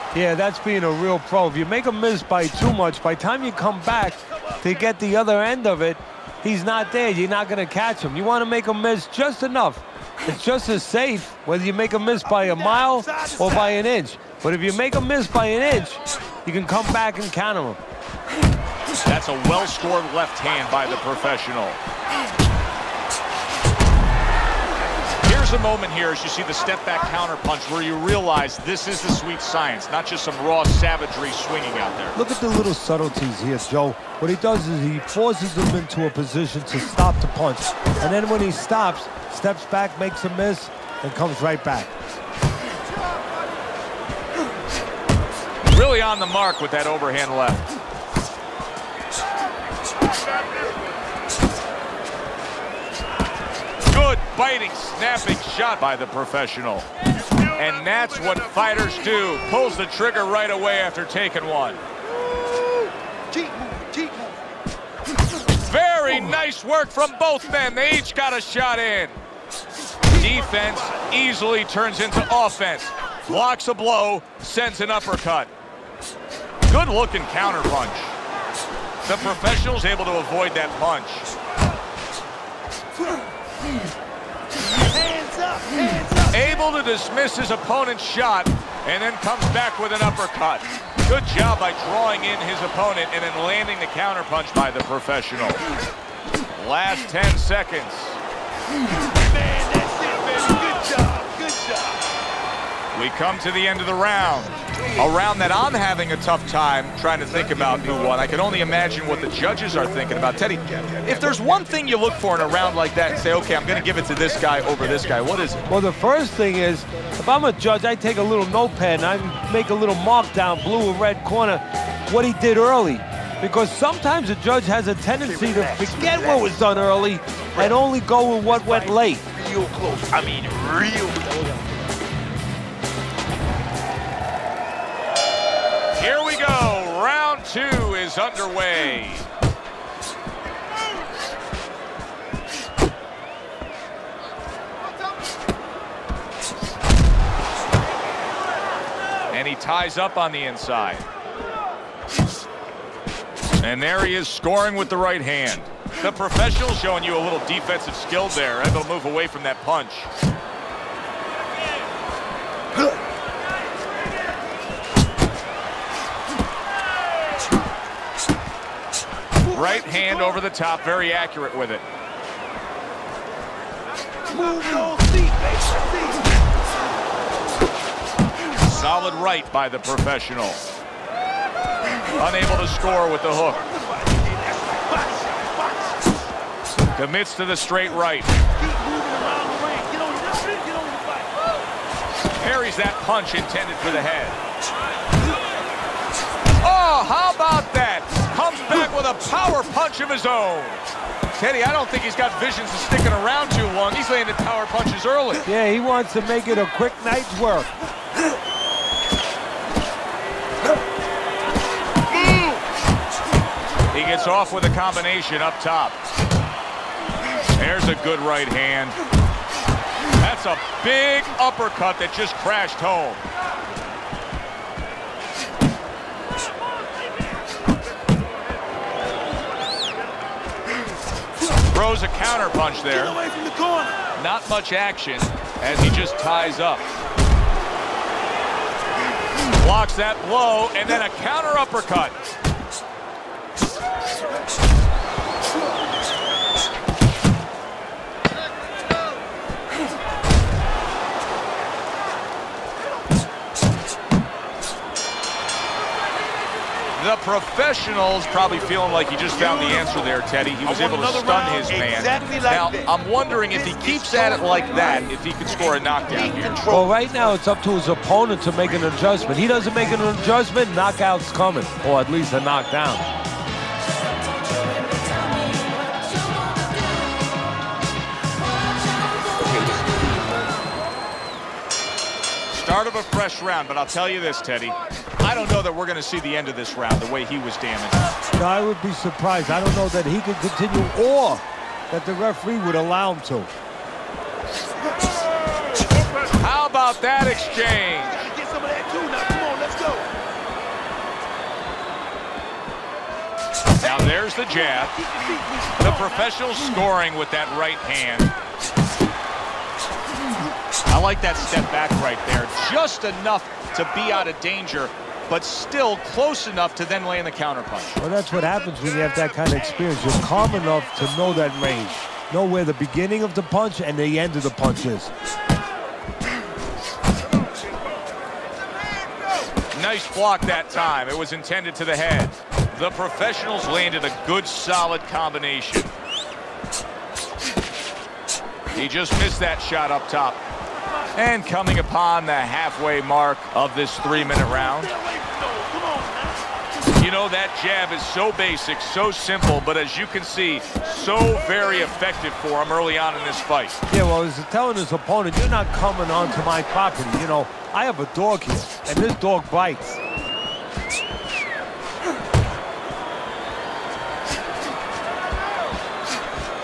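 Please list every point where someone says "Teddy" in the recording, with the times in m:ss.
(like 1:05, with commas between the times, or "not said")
1:50, 3:21, 4:20, 4:44.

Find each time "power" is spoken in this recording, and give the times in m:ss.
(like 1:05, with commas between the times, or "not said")
3:19, 3:24.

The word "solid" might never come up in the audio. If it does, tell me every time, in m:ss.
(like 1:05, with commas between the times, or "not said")
2:58, 5:34.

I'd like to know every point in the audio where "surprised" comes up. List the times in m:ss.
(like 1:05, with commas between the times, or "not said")
4:48.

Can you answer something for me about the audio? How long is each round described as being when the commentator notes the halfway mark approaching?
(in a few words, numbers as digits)
3 minutes.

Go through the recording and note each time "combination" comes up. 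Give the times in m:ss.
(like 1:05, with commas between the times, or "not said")
3:34, 5:35.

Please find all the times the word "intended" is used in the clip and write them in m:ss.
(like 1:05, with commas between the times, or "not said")
3:13, 5:31.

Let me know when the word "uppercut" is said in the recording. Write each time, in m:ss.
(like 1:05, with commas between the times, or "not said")
1:14, 1:30, 3:41, 4:01.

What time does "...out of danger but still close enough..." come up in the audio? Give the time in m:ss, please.
5:14.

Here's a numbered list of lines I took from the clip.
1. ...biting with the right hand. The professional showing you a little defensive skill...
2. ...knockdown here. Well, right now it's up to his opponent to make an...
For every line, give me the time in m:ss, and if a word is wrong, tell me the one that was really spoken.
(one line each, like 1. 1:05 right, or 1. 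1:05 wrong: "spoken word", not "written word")
1. 2:34 wrong: "scoring", not "biting"
2. 4:25 right.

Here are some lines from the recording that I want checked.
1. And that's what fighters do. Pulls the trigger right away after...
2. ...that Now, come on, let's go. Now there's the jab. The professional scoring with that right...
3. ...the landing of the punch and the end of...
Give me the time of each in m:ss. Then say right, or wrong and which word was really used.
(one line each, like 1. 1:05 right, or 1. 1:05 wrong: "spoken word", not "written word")
1. 0:57 right
2. 4:58 right
3. 5:22 wrong: "beginning", not "landing".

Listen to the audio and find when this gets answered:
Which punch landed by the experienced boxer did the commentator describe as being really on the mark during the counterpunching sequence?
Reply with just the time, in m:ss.
0:46.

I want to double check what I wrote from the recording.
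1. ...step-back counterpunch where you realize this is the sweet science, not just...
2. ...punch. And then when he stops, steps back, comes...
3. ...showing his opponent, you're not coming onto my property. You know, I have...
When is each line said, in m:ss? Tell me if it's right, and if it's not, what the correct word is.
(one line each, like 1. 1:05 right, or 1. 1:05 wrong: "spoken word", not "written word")
1. 0:26 right
2. 0:37 wrong: "makes", not "comes"
3. 5:54 wrong: "telling", not "showing".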